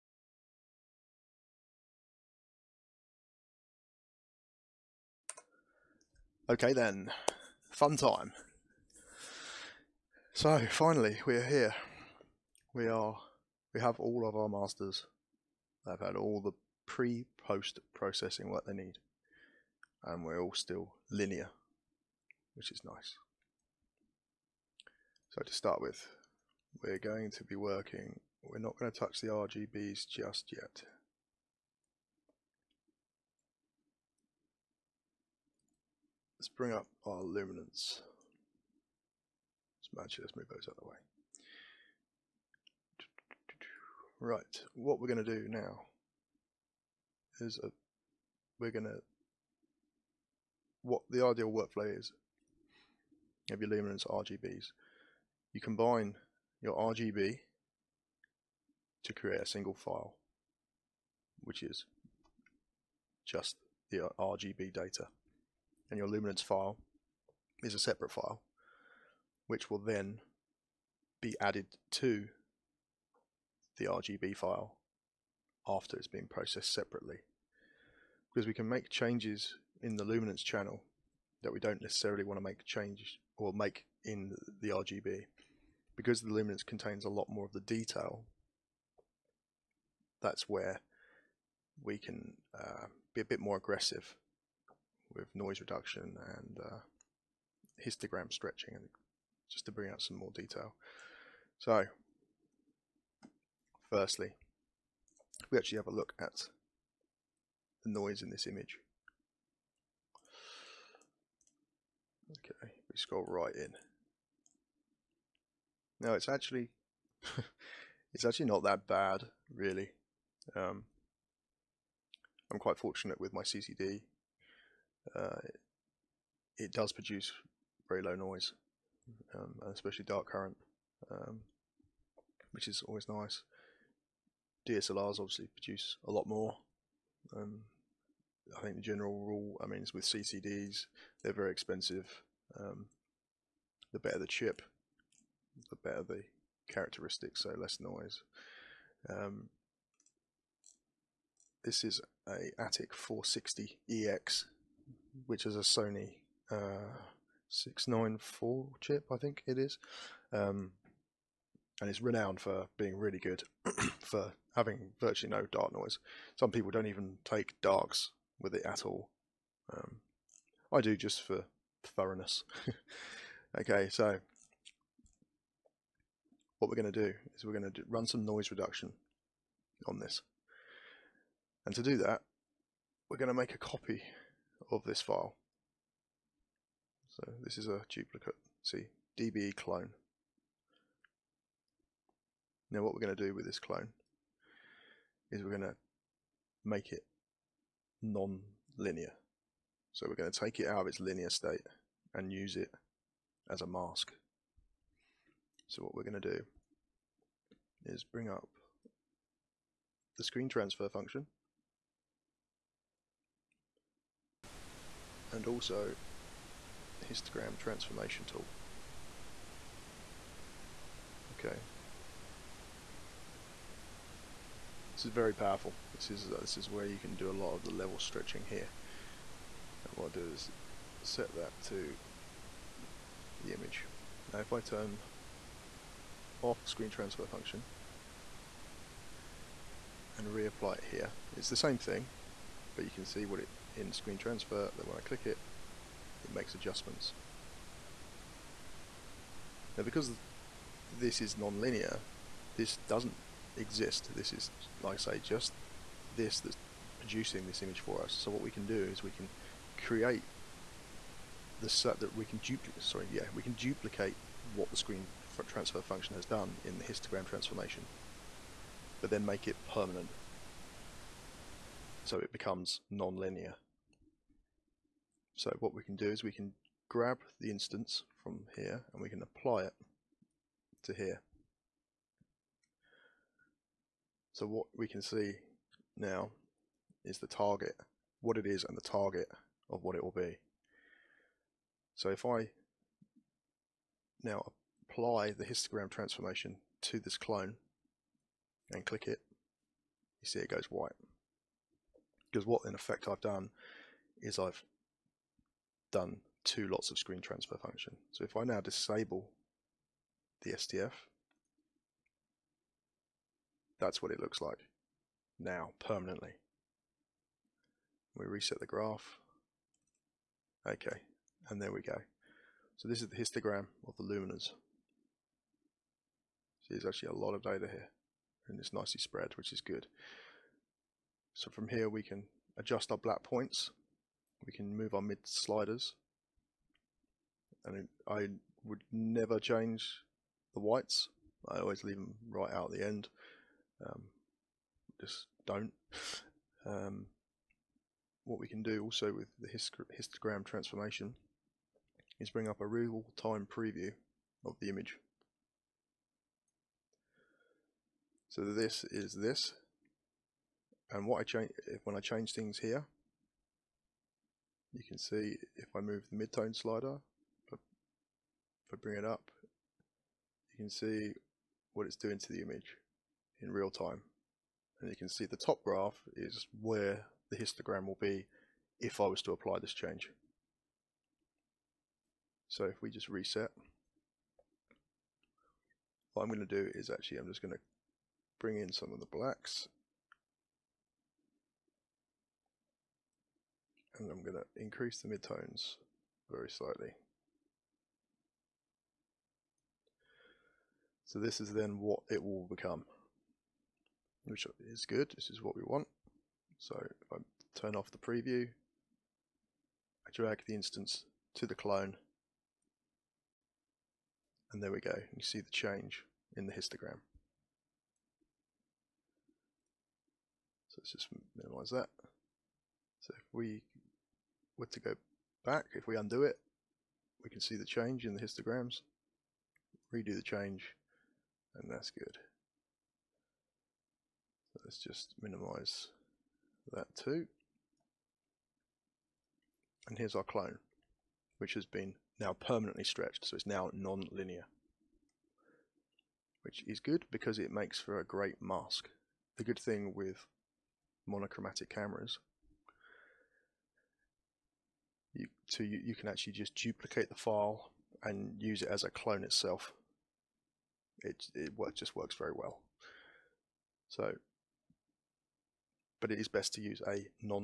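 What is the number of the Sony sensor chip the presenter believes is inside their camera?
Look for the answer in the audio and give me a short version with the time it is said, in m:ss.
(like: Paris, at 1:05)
694, at 2:37.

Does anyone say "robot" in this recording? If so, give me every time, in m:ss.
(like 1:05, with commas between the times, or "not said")
not said.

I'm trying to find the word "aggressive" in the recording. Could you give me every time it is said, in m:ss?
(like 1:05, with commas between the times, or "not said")
1:33.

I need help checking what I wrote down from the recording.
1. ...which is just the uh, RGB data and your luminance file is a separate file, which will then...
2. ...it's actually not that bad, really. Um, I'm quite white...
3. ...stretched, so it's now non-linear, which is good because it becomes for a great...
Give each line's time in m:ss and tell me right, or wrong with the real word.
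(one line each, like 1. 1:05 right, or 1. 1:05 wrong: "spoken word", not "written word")
1. 1:01 right
2. 1:58 wrong: "fortunate", not "white"
3. 7:22 wrong: "makes", not "becomes".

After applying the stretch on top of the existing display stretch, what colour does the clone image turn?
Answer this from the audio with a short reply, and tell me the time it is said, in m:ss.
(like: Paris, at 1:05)
white, at 5:00.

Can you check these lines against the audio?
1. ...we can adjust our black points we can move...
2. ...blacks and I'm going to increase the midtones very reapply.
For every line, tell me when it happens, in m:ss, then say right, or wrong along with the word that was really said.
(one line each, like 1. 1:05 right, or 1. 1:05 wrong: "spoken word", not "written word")
1. 5:31 right
2. 6:29 wrong: "slightly", not "reapply".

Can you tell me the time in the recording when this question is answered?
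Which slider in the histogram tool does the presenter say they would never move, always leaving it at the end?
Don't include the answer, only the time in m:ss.
5:40.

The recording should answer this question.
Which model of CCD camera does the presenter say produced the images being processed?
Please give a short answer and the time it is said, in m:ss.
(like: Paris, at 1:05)
Atik 460EX, at 2:32.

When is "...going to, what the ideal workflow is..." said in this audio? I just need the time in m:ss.
0:48.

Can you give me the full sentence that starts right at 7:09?
Redo the change, and that's good.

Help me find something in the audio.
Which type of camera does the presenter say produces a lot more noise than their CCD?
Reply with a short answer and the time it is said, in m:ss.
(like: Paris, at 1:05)
DSLRs, at 2:14.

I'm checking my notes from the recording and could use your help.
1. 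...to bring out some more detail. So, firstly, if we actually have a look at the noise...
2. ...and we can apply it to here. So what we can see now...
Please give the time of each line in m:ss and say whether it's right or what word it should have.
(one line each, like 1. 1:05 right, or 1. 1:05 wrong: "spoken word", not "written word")
1. 1:39 right
2. 4:38 right.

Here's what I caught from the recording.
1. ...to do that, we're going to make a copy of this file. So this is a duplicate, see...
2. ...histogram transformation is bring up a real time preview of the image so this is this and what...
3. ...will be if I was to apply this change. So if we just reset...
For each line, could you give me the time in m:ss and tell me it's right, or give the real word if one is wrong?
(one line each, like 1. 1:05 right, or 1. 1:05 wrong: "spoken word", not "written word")
1. 3:01 right
2. 5:49 right
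3. 6:17 right.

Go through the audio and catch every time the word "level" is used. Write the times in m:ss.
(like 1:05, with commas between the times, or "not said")
3:47.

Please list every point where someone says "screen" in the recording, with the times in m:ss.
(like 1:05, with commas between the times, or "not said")
3:30, 3:56, 4:03, 4:24, 5:06.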